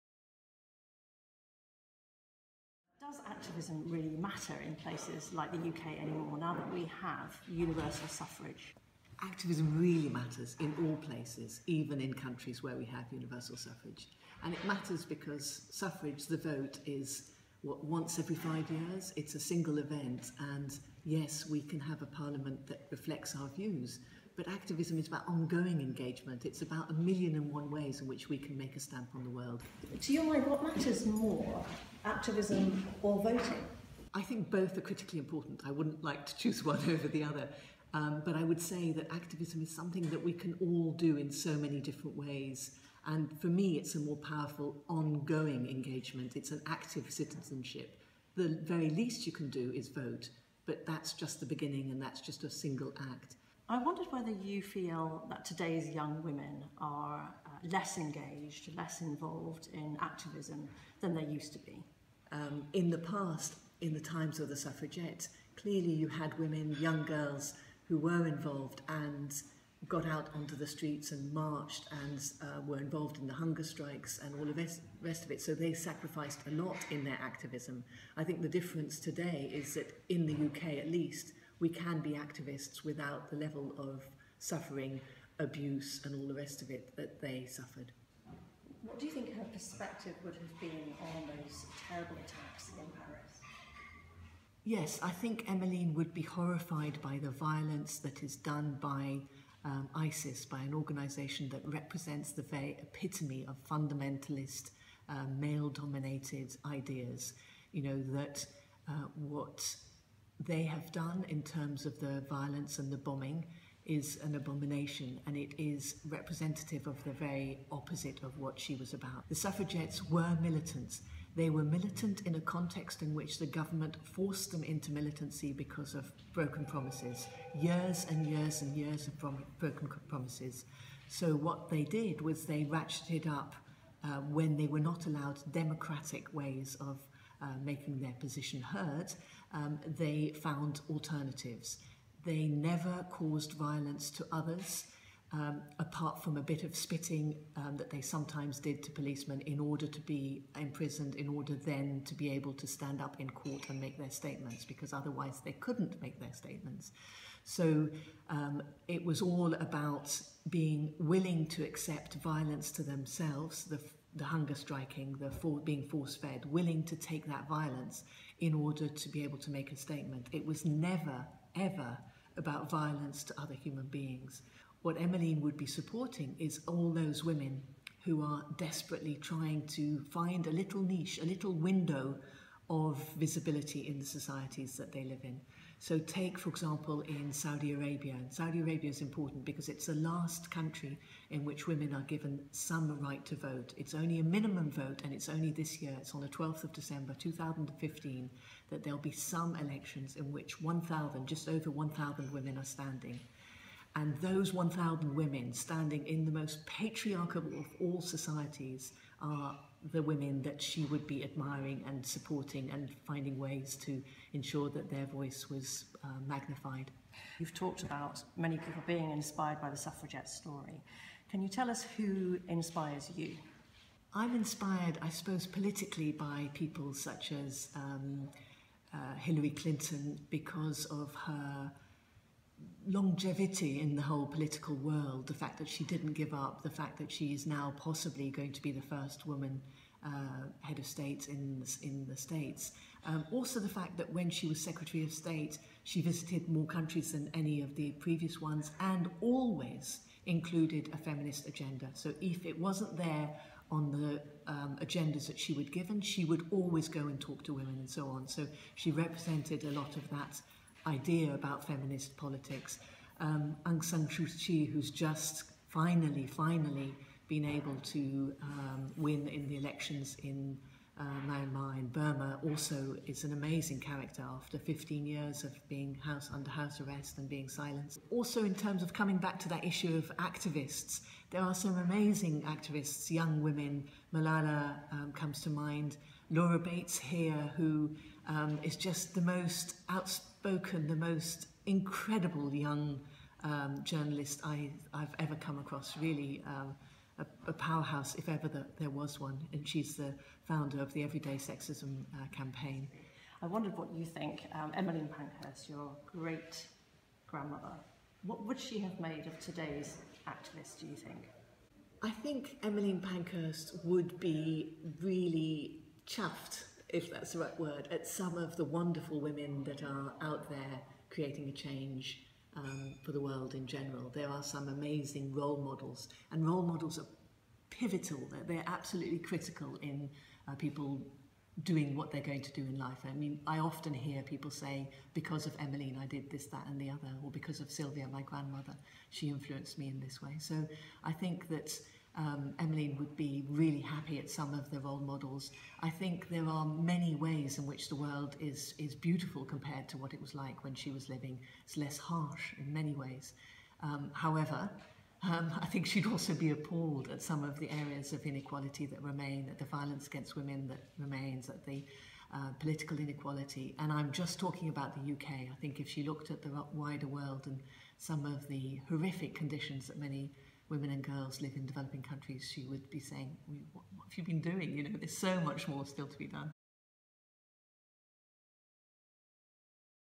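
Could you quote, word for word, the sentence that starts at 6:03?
And I'm just talking about the UK.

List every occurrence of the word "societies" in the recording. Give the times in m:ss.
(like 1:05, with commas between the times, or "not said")
3:04, 3:27.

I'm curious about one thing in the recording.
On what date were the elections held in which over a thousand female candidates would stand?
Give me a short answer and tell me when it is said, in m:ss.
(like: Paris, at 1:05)
12 December 2015, at 3:16.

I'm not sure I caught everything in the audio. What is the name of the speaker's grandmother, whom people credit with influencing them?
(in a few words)
Sylvia.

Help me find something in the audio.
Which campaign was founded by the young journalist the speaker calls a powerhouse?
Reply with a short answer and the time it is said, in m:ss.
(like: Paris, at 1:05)
Everyday Sexism, at 5:01.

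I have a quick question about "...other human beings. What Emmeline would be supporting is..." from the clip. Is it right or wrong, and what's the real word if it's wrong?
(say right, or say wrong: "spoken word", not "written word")
right.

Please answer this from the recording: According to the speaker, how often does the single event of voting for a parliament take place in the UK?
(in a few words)
Once every 5 years.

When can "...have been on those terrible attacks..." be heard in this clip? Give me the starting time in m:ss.
1:30.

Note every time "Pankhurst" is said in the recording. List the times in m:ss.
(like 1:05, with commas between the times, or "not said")
5:05, 5:13.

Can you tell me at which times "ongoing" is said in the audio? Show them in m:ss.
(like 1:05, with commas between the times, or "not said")
0:25, 0:44.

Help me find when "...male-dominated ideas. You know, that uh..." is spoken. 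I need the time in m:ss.
1:45.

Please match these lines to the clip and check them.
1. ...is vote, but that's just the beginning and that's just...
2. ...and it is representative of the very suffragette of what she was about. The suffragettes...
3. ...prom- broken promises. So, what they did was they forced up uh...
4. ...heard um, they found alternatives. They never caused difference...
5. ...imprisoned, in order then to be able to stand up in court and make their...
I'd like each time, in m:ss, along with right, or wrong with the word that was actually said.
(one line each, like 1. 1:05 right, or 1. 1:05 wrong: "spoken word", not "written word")
1. 0:49 right
2. 1:55 wrong: "opposite", not "suffragette"
3. 2:09 wrong: "ratcheted", not "forced"
4. 2:18 wrong: "violence", not "difference"
5. 2:30 right.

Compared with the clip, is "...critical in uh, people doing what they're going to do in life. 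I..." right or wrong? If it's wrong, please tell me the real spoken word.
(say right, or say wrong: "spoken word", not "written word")
right.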